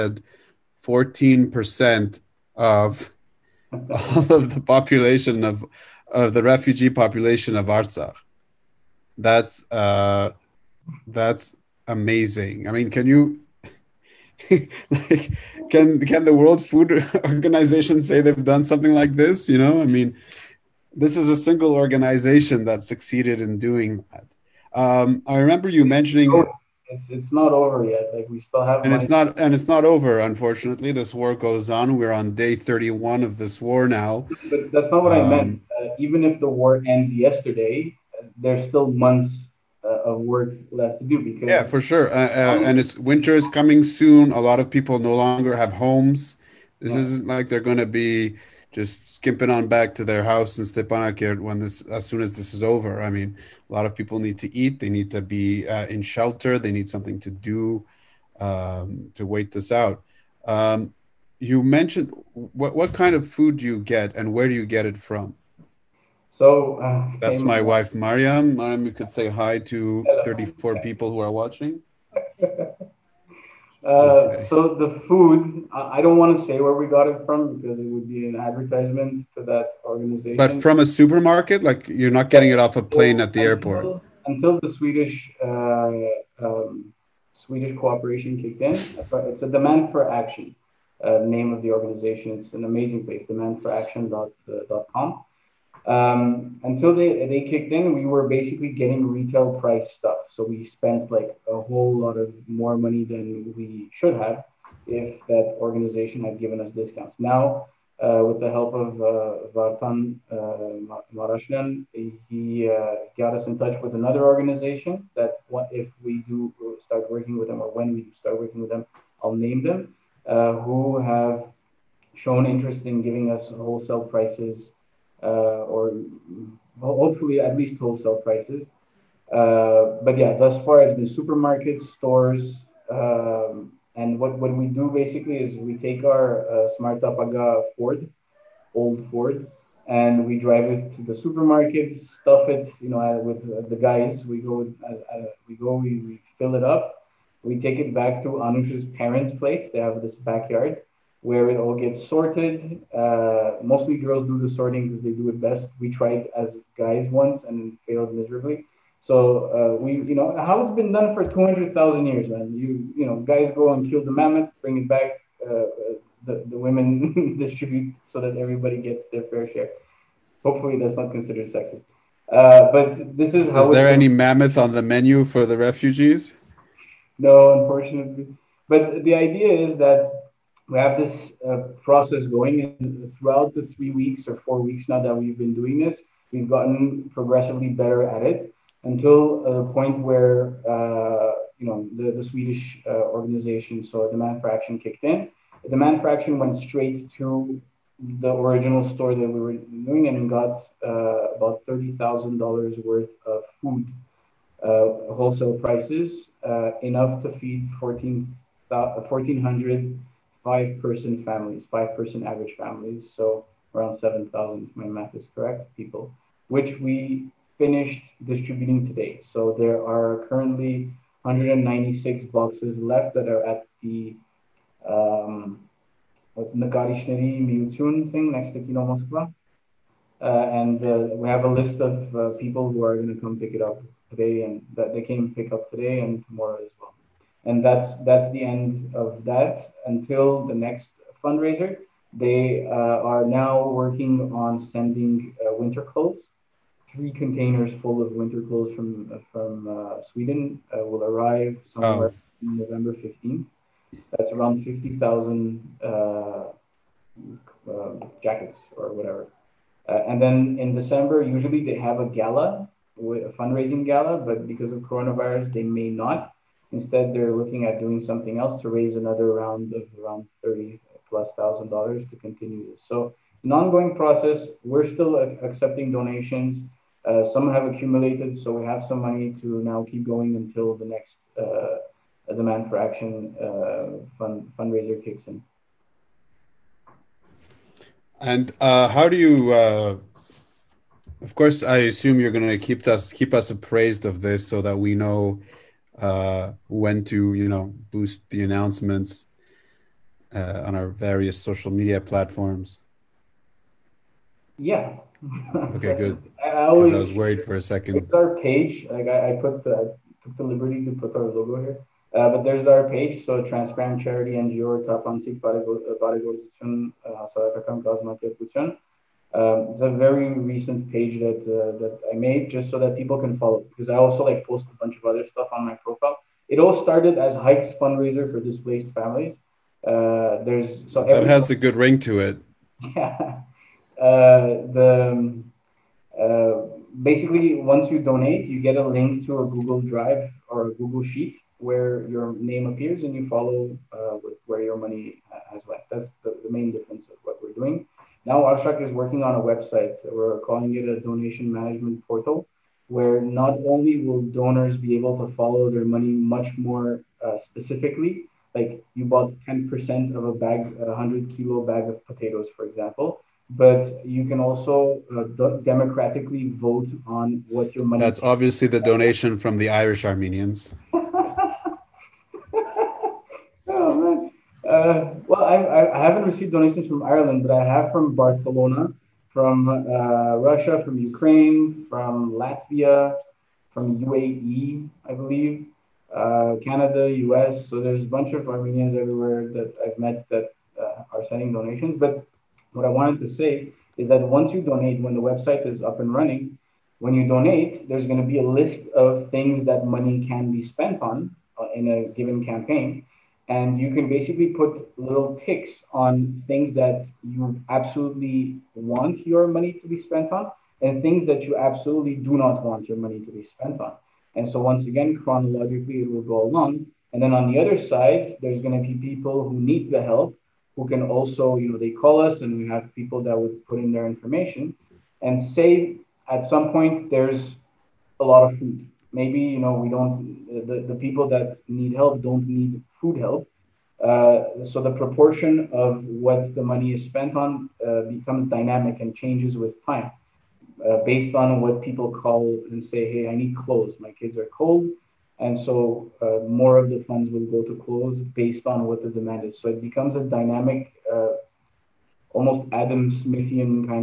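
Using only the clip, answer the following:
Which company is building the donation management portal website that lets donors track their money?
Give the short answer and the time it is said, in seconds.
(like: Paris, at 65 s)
Abstract, at 348 s.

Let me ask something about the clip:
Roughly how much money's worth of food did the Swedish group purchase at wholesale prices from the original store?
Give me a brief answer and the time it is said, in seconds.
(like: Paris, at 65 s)
$30,000, at 201 s.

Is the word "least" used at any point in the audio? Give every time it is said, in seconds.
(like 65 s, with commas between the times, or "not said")
127 s.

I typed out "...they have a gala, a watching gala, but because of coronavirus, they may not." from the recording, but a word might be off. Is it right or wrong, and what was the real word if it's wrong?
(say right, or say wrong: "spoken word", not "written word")
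wrong: "fundraising", not "watching".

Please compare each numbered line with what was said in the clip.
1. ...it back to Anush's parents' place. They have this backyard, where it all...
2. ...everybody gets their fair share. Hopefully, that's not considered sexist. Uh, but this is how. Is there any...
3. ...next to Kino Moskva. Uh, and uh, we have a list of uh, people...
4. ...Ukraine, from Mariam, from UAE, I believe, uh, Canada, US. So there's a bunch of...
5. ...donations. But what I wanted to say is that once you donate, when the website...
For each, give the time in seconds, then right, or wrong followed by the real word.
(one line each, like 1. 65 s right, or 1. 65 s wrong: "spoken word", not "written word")
1. 147 s right
2. 168 s right
3. 228 s right
4. 380 s wrong: "Latvia", not "Mariam"
5. 391 s right.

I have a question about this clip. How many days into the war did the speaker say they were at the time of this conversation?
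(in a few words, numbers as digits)
31.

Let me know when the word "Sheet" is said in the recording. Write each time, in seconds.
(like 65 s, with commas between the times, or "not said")
341 s.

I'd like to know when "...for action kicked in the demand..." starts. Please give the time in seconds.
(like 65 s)
194 s.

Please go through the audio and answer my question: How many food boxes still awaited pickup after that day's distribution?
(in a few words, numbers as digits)
196.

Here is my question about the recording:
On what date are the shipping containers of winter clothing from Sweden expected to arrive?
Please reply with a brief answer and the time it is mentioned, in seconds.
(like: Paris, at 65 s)
November 15, at 252 s.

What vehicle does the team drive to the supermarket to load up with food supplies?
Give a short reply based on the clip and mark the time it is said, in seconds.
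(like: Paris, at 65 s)
old Ford, at 138 s.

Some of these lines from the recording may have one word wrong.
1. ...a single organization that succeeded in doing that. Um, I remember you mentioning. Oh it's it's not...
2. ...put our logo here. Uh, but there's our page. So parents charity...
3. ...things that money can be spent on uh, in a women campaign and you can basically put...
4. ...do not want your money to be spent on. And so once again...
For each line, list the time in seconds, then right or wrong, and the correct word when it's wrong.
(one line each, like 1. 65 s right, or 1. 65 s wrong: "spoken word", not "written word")
1. 21 s right
2. 310 s wrong: "transparent", not "parents"
3. 399 s wrong: "given", not "women"
4. 412 s right.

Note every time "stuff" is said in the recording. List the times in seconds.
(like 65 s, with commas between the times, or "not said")
99 s, 142 s, 325 s.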